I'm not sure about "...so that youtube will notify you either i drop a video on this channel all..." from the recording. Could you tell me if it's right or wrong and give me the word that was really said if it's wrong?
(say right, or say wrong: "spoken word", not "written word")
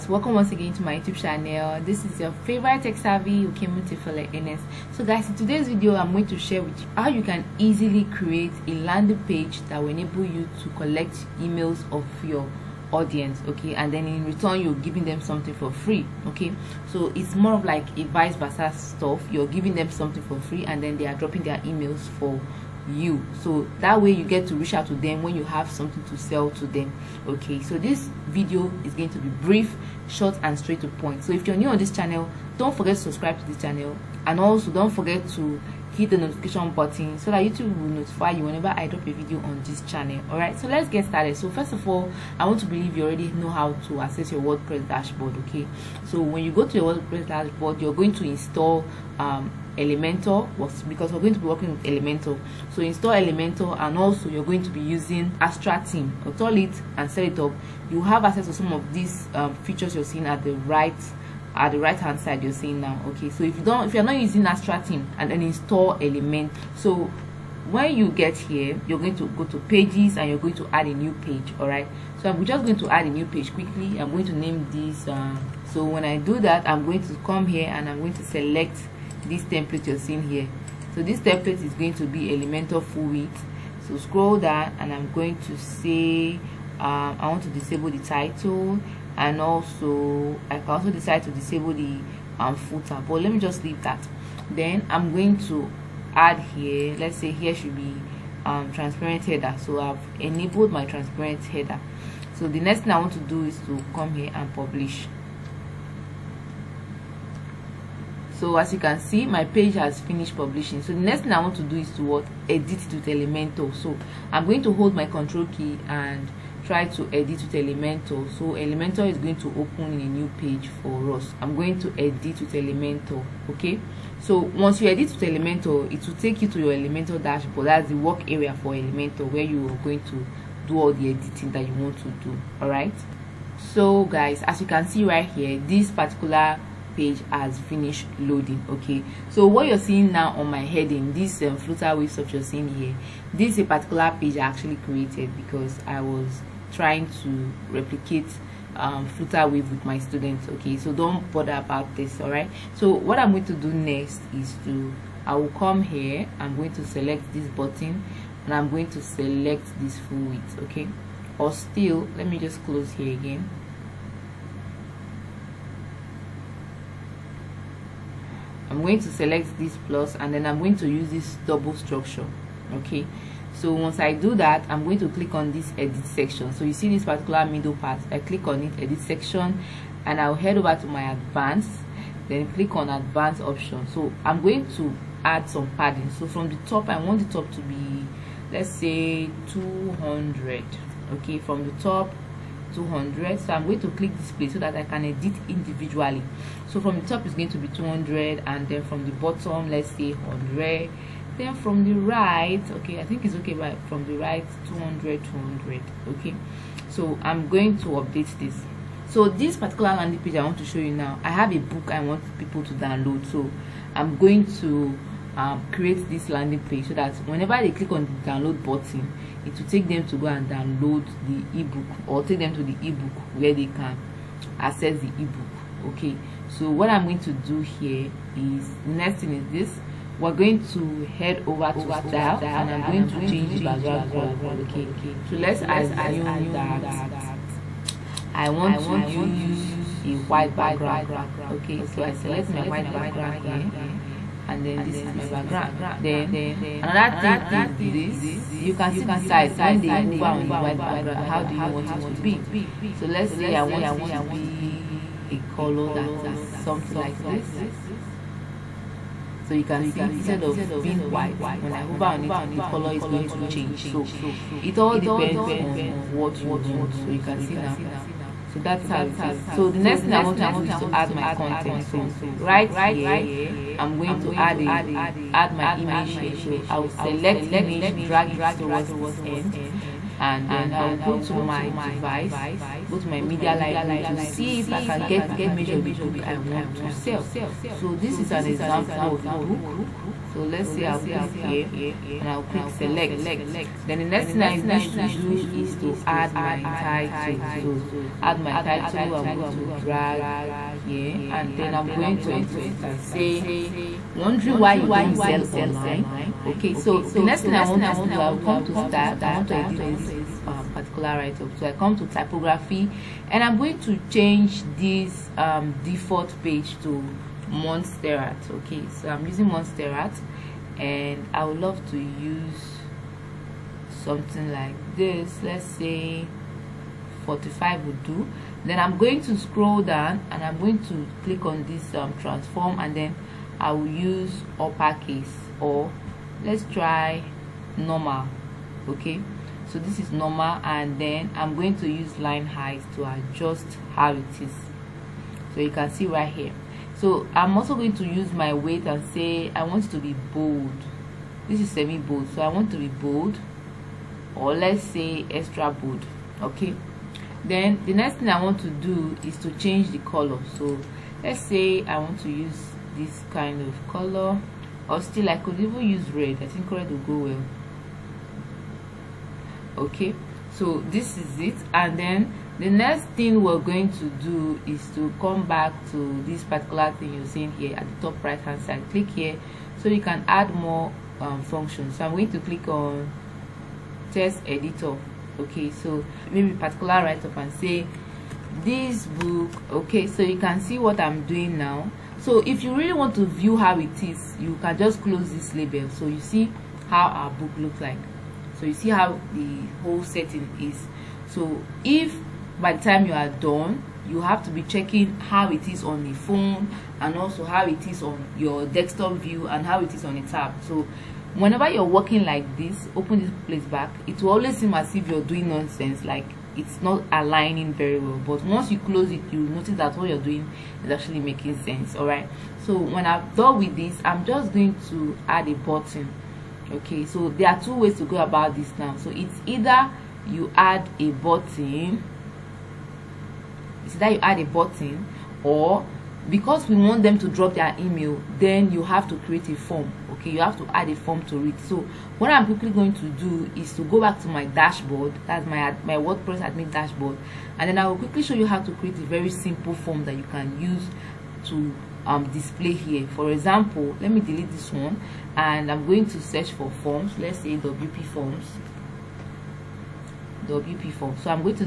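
wrong: "whenever", not "either".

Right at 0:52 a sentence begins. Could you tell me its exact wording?
So install Elementor and also you're going to be using Astra Theme.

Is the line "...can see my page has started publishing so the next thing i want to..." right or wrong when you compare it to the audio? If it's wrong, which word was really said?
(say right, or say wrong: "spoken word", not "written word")
wrong: "finished", not "started".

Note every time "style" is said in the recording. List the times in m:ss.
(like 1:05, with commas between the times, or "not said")
3:51.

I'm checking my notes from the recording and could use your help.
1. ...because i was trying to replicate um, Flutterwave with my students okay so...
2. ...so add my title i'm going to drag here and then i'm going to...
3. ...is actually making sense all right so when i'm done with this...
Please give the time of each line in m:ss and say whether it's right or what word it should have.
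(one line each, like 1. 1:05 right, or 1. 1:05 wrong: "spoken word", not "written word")
1. 2:25 right
2. 4:57 right
3. 7:00 right.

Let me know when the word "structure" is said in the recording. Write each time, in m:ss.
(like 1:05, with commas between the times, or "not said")
2:51.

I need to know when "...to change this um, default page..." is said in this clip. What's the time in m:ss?
5:13.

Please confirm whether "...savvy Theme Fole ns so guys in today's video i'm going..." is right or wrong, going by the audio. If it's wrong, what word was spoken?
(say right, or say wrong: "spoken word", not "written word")
wrong: "Okiemute", not "Theme".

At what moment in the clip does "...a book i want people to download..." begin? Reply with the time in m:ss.
3:31.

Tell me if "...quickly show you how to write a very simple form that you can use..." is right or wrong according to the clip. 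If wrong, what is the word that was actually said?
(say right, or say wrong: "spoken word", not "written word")
wrong: "create", not "write".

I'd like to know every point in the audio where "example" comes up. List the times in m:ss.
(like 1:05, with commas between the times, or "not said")
4:48, 7:33.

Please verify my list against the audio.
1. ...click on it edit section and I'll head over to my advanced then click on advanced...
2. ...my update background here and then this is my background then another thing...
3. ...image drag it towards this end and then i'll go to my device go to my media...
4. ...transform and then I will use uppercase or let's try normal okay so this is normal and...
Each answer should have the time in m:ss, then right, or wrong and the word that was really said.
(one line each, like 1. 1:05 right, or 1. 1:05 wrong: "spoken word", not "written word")
1. 2:58 right
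2. 4:02 wrong: "white", not "update"
3. 4:37 right
4. 5:32 right.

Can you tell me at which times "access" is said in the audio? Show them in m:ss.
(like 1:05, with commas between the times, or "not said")
0:44, 0:58, 3:44.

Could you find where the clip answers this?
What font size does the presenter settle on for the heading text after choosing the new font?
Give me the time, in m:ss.
5:27.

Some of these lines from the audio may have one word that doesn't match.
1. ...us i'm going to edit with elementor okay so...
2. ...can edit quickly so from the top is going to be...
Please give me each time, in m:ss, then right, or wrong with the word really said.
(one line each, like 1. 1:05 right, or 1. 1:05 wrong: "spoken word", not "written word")
1. 2:01 right
2. 3:14 wrong: "individually", not "quickly".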